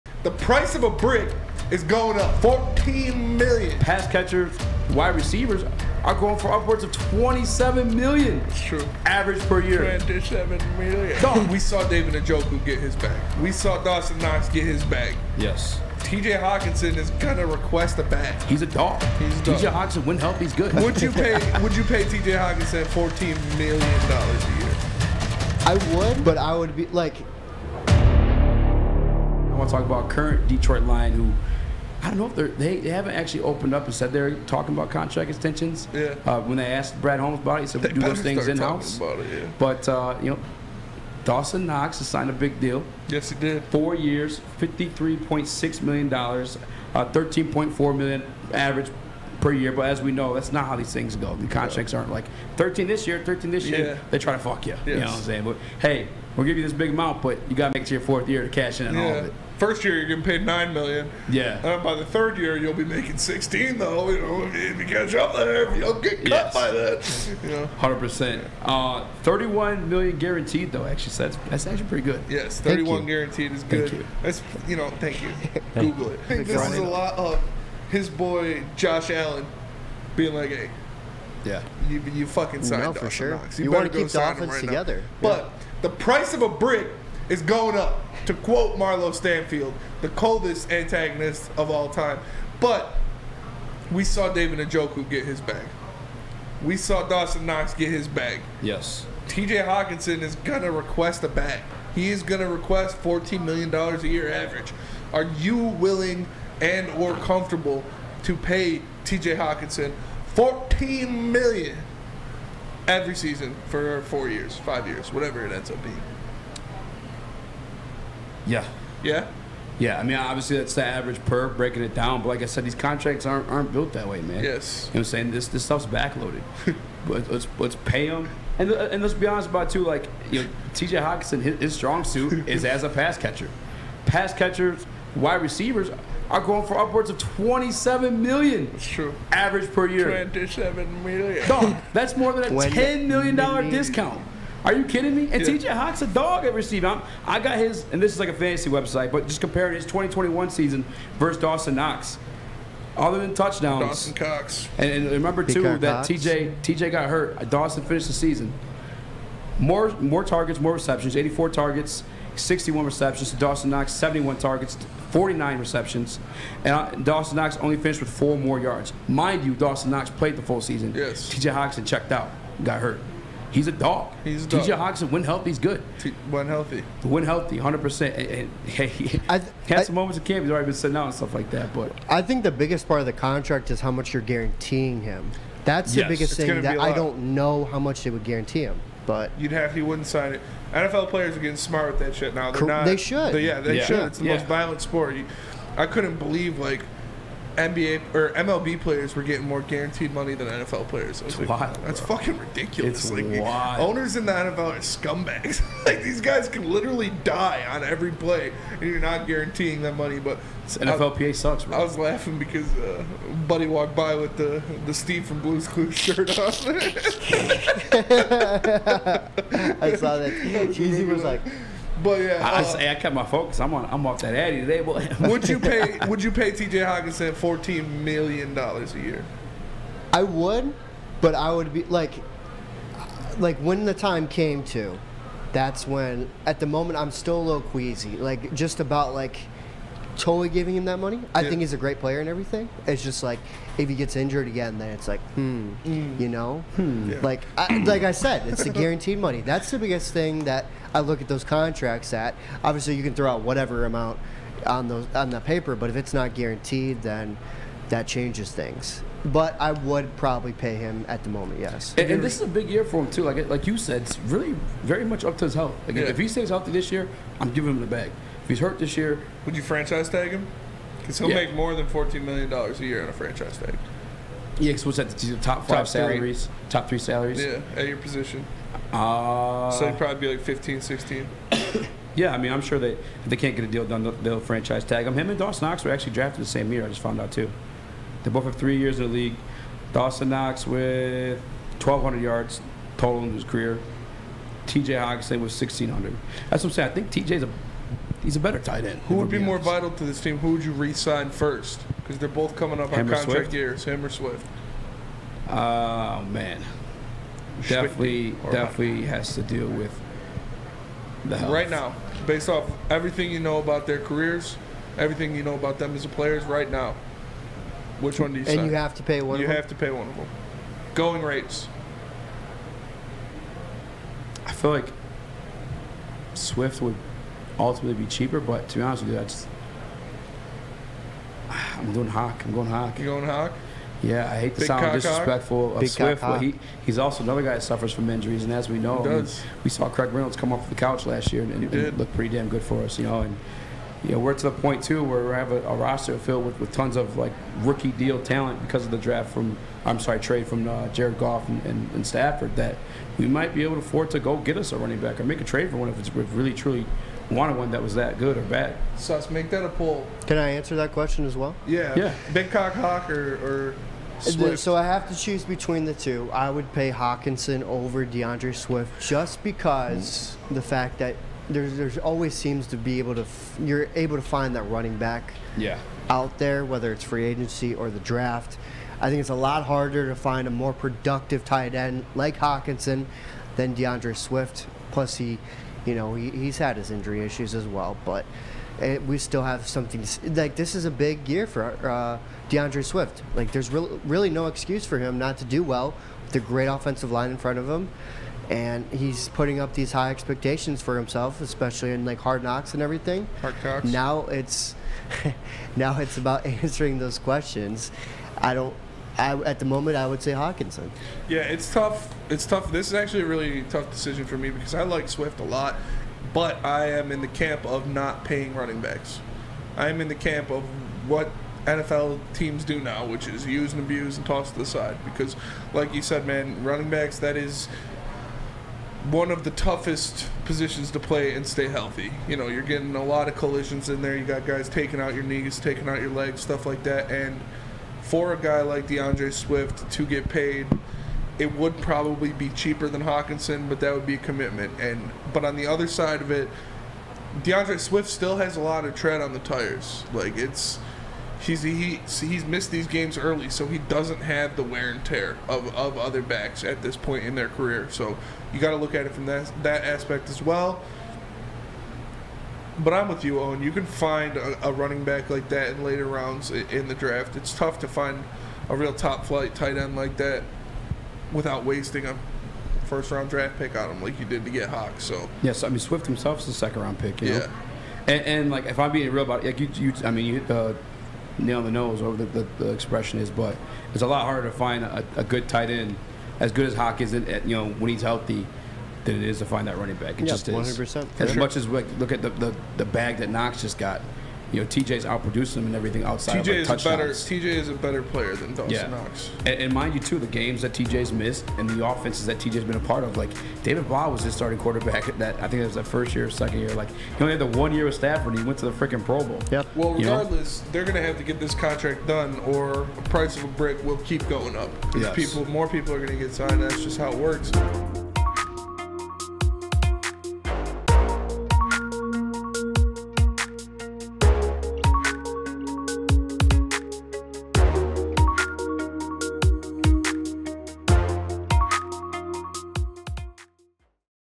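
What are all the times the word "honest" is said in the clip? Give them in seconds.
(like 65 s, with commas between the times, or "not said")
129 s, 328 s.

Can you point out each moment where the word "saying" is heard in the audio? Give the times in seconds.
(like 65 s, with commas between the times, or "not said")
55 s, 125 s, 296 s.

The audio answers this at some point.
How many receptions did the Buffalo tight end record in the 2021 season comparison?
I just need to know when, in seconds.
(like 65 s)
162 s.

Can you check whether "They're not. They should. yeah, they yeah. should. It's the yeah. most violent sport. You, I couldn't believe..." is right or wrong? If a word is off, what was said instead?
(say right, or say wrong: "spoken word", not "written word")
right.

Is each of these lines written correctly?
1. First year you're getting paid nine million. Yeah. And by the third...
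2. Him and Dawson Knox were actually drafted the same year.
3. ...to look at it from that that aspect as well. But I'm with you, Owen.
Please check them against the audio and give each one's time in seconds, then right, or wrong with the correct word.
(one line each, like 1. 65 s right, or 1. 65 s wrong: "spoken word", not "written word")
1. 59 s right
2. 285 s right
3. 458 s right.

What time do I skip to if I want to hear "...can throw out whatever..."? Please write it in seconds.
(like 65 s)
253 s.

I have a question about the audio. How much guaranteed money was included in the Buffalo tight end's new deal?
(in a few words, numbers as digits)
$31 million.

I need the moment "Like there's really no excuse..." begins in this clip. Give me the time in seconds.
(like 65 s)
393 s.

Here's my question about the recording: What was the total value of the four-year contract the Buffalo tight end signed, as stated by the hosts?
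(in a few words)
$53.6 million.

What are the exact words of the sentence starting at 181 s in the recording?
But I think the biggest part of the contract is how much you're guaranteeing him.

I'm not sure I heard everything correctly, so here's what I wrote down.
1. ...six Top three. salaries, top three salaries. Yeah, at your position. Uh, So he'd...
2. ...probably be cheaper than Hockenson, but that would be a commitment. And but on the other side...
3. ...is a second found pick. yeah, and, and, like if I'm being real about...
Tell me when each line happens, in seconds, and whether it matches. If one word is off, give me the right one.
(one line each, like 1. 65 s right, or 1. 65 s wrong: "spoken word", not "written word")
1. 275 s wrong: "five", not "six"
2. 441 s right
3. 476 s wrong: "round", not "found".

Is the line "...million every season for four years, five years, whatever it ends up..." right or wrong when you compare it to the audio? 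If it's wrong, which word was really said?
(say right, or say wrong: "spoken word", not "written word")
right.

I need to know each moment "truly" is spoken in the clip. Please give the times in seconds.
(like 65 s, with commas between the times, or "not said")
356 s.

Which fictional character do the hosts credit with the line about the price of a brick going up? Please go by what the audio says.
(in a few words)
Marlo Stanfield.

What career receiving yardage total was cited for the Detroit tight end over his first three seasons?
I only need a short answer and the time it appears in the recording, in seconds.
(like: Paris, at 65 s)
1,600, at 295 s.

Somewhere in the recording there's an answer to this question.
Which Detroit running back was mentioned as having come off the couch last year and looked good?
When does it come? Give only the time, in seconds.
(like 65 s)
339 s.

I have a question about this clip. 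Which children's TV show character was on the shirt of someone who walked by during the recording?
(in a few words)
Steve from Blue's Clues.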